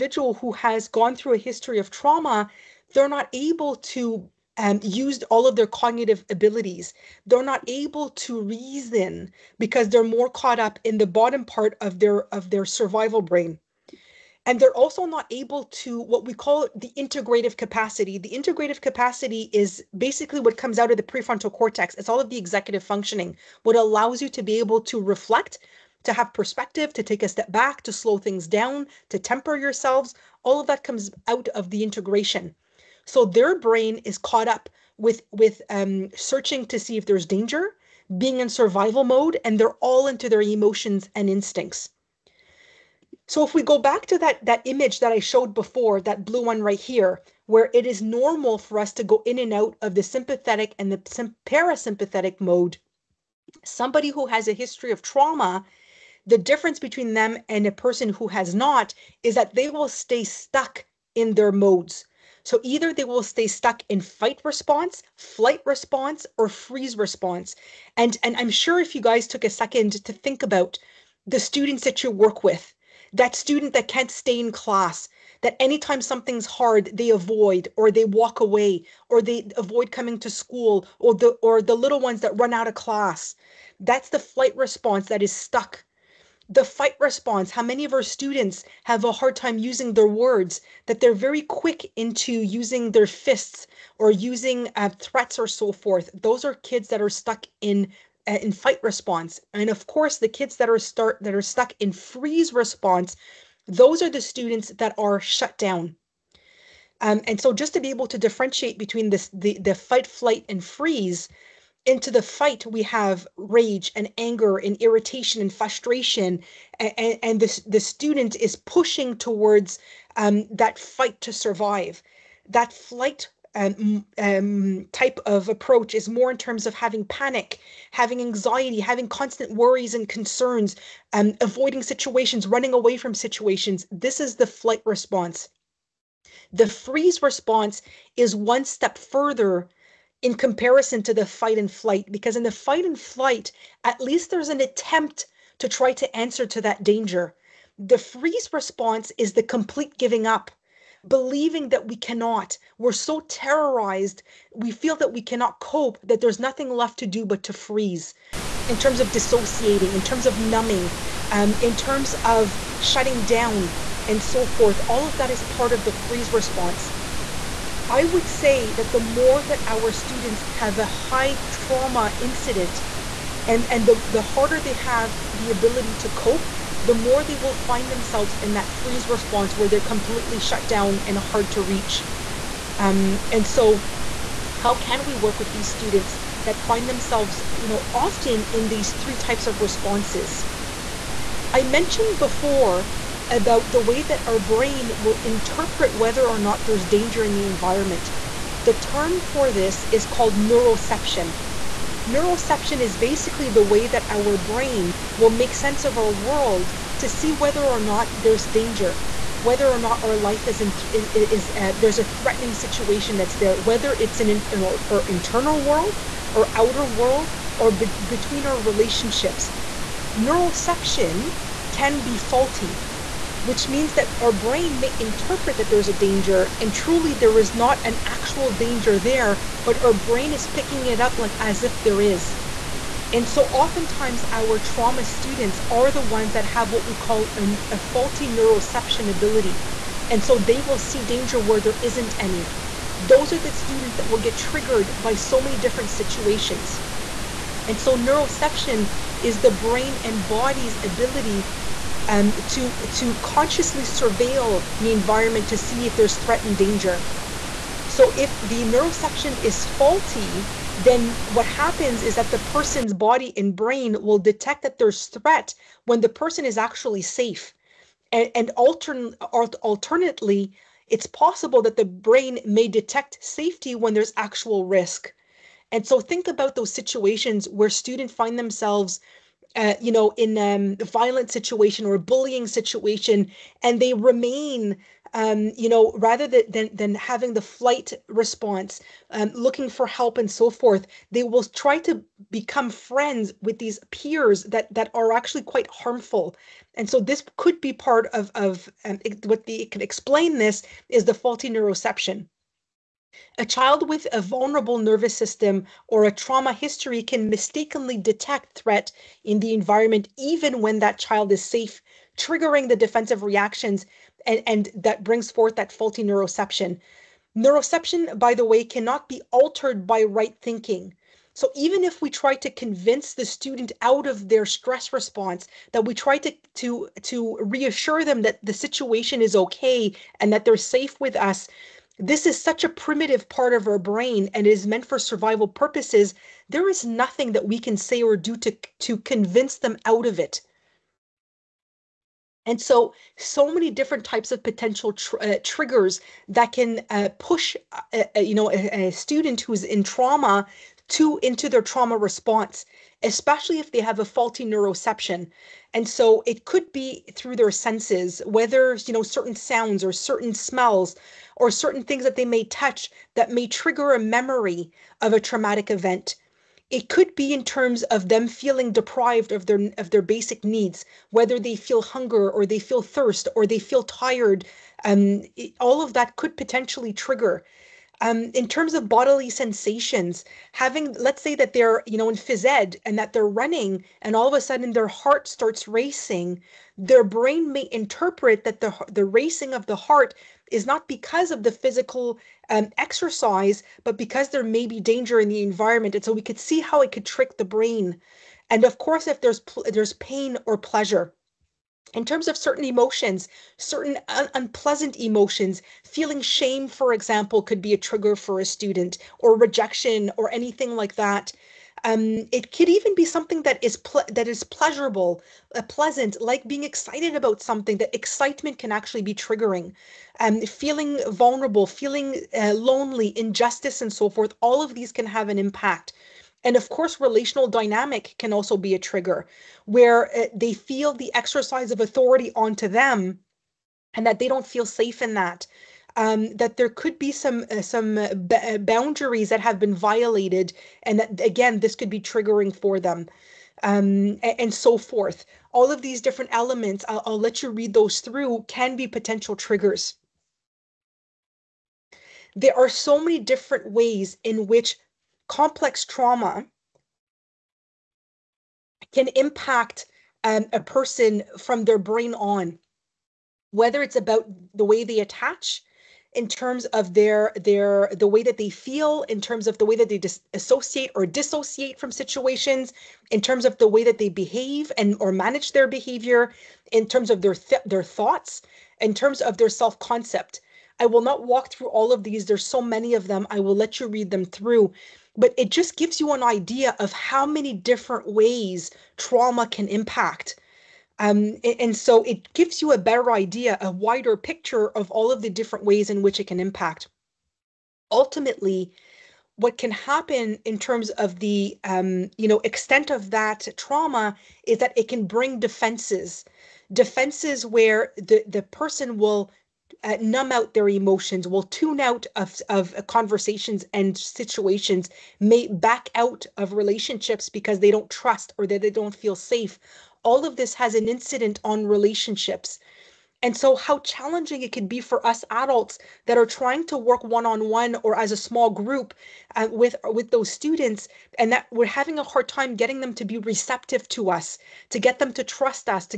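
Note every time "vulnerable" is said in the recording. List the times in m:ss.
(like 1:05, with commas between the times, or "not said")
5:04, 7:01.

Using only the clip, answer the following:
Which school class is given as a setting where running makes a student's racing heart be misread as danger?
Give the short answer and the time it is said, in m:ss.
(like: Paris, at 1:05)
Phys ed, at 6:22.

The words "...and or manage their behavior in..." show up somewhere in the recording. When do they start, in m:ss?
7:54.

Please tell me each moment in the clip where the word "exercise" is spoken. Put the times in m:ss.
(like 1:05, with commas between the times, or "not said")
6:32, 7:11.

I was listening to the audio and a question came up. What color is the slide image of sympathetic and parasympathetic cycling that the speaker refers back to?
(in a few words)
Blue.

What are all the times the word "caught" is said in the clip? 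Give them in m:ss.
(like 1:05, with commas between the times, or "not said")
0:10, 0:34.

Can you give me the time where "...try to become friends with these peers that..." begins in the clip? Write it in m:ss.
4:51.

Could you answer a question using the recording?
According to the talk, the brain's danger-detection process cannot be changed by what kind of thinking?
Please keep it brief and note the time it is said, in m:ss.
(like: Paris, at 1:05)
Right thinking, at 5:20.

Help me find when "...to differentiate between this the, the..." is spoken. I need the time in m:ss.
1:48.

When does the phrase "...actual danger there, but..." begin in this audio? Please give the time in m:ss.
3:48.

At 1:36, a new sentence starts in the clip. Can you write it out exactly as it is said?
Those are kids that are stuck in uh, in fight response.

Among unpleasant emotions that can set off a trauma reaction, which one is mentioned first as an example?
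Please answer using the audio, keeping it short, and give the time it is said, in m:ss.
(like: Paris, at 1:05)
Shame, at 6:46.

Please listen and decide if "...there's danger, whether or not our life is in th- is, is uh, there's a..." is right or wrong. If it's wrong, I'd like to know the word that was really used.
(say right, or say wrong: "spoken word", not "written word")
right.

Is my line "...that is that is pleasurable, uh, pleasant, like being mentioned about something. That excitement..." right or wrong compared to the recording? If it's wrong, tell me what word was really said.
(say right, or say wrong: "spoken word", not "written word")
wrong: "excited", not "mentioned".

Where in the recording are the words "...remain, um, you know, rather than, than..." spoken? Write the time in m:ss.
4:43.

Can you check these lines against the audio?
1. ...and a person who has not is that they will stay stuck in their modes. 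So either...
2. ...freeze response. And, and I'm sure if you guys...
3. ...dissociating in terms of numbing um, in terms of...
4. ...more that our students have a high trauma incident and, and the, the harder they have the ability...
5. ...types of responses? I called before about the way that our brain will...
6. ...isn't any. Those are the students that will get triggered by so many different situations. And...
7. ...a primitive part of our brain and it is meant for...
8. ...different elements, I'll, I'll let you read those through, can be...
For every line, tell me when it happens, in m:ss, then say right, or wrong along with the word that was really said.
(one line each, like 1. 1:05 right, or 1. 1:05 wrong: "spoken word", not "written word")
1. 0:57 right
2. 1:06 right
3. 2:39 right
4. 2:48 right
5. 3:09 wrong: "mentioned", not "called"
6. 4:01 right
7. 5:32 right
8. 7:25 right.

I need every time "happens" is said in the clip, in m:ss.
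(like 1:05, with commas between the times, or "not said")
4:21, 8:19.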